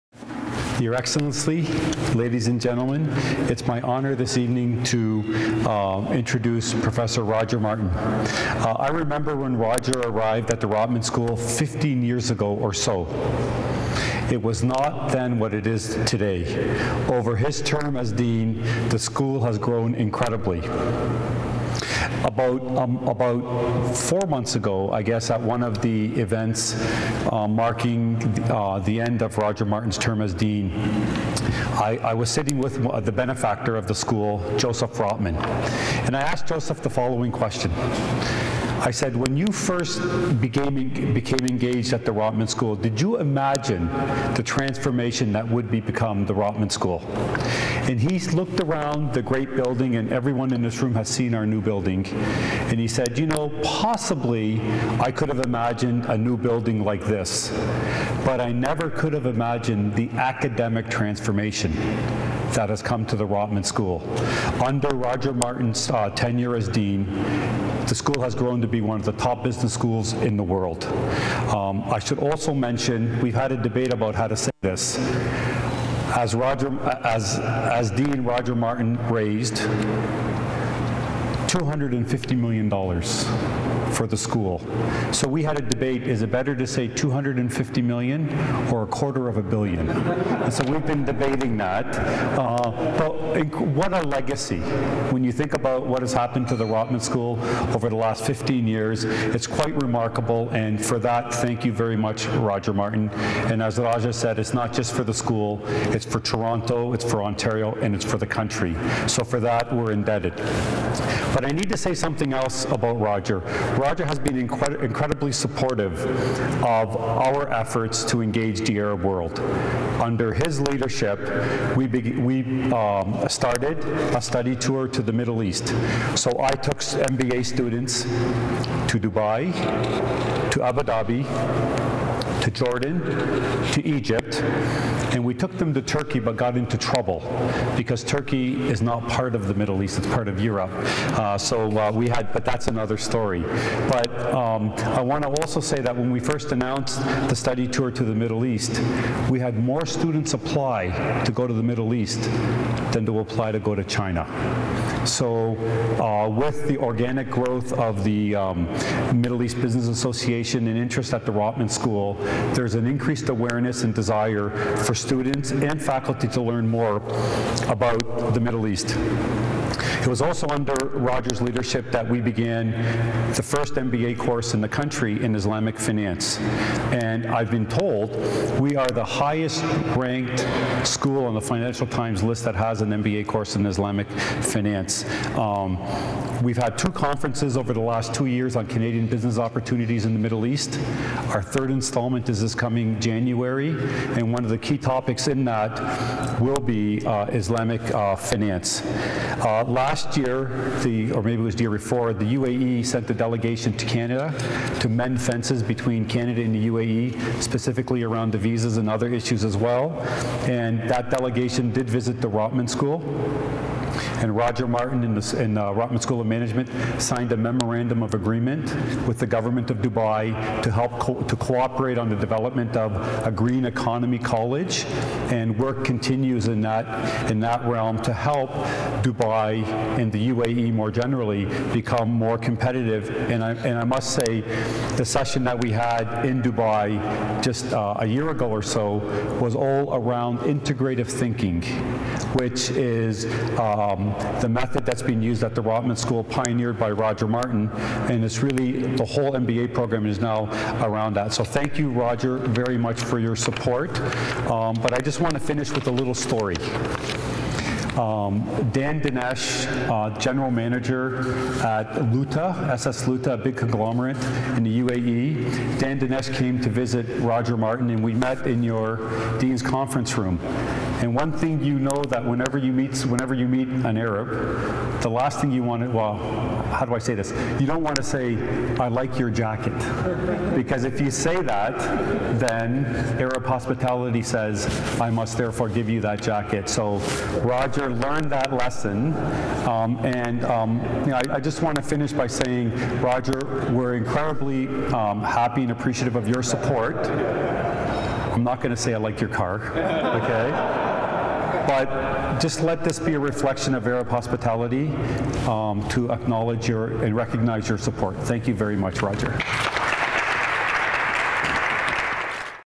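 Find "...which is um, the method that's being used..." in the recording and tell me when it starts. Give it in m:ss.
4:02.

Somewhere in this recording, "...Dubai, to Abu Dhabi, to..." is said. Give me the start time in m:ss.
2:08.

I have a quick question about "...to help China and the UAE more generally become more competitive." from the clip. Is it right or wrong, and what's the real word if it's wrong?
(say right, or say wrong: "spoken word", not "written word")
wrong: "Dubai", not "China".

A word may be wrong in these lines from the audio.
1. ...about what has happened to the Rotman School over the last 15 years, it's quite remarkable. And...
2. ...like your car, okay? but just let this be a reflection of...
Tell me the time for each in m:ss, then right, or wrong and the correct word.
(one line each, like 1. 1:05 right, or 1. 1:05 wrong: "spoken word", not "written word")
1. 1:35 right
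2. 4:58 right.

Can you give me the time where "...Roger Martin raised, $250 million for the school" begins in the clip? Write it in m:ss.
1:18.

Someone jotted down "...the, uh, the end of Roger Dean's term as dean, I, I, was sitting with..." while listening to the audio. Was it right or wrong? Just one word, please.
wrong.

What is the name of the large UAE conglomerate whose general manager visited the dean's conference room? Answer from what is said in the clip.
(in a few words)
SS Lootah.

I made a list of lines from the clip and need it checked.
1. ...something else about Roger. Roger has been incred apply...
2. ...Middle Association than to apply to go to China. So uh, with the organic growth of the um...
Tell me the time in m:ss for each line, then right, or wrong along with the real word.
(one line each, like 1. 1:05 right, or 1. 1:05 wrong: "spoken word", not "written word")
1. 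1:51 wrong: "incredibly", not "apply"
2. 2:31 wrong: "East", not "Association".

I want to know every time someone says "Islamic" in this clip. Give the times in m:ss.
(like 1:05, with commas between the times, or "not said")
2:55, 3:03, 3:17.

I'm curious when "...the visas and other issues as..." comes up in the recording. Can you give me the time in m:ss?
3:28.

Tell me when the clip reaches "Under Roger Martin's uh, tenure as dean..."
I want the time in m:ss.
1:04.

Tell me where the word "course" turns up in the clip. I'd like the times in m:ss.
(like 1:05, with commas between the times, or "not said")
2:54, 3:03.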